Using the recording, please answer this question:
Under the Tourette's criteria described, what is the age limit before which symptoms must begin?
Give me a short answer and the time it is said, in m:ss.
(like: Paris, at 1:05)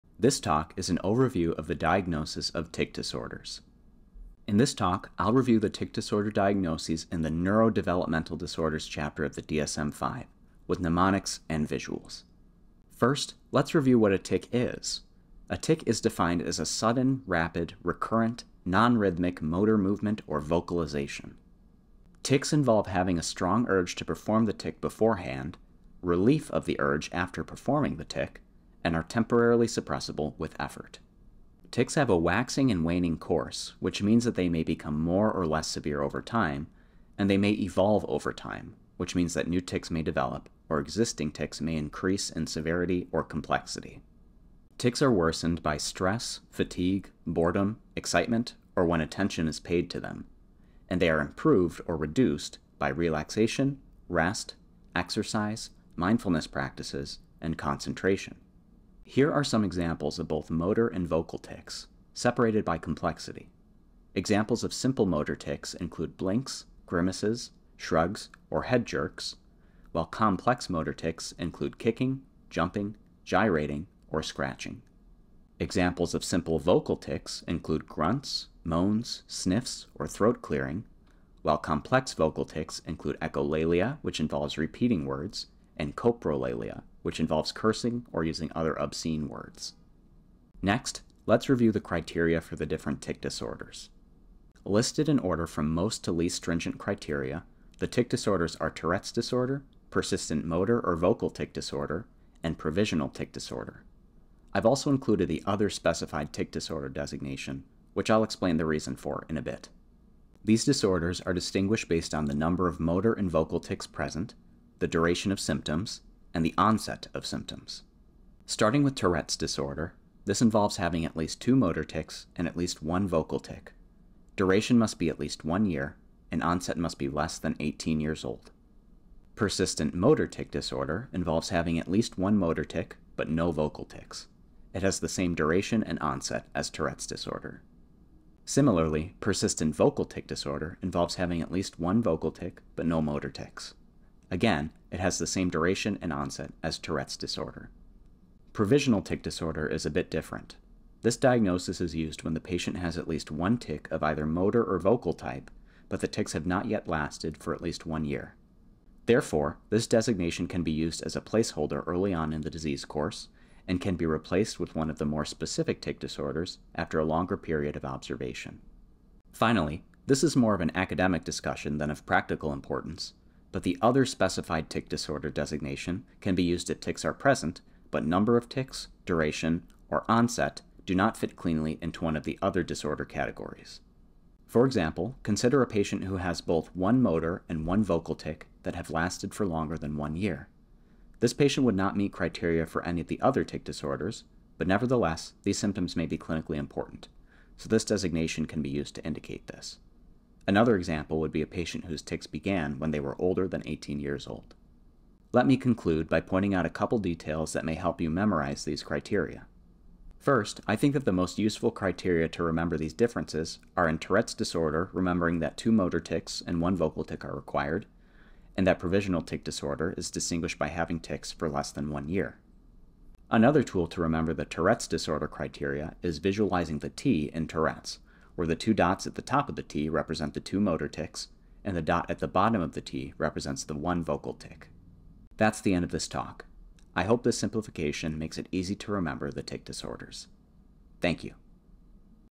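18 years old, at 2:07.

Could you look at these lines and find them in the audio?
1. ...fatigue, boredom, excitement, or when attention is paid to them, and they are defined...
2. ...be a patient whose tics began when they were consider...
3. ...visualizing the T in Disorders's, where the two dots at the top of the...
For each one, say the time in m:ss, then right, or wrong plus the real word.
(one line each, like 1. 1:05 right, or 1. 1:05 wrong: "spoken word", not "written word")
1. 0:46 wrong: "improved", not "defined"
2. 3:21 wrong: "older", not "consider"
3. 3:46 wrong: "Tourette", not "Disorders".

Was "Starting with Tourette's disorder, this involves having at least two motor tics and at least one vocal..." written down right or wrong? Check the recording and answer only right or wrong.
right.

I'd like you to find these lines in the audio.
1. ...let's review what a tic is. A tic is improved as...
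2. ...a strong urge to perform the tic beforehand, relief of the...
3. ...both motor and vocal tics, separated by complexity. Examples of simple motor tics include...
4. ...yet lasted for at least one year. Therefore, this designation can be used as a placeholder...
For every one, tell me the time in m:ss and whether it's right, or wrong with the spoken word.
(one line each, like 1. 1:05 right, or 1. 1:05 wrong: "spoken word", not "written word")
1. 0:13 wrong: "defined", not "improved"
2. 0:23 right
3. 1:00 right
4. 2:36 right.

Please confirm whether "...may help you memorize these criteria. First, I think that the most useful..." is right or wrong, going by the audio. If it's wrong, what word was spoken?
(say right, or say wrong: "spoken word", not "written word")
right.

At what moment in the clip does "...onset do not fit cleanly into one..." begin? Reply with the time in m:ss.
3:00.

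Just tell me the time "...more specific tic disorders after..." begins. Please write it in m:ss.
2:45.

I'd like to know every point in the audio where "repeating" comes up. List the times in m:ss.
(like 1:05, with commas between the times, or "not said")
1:24.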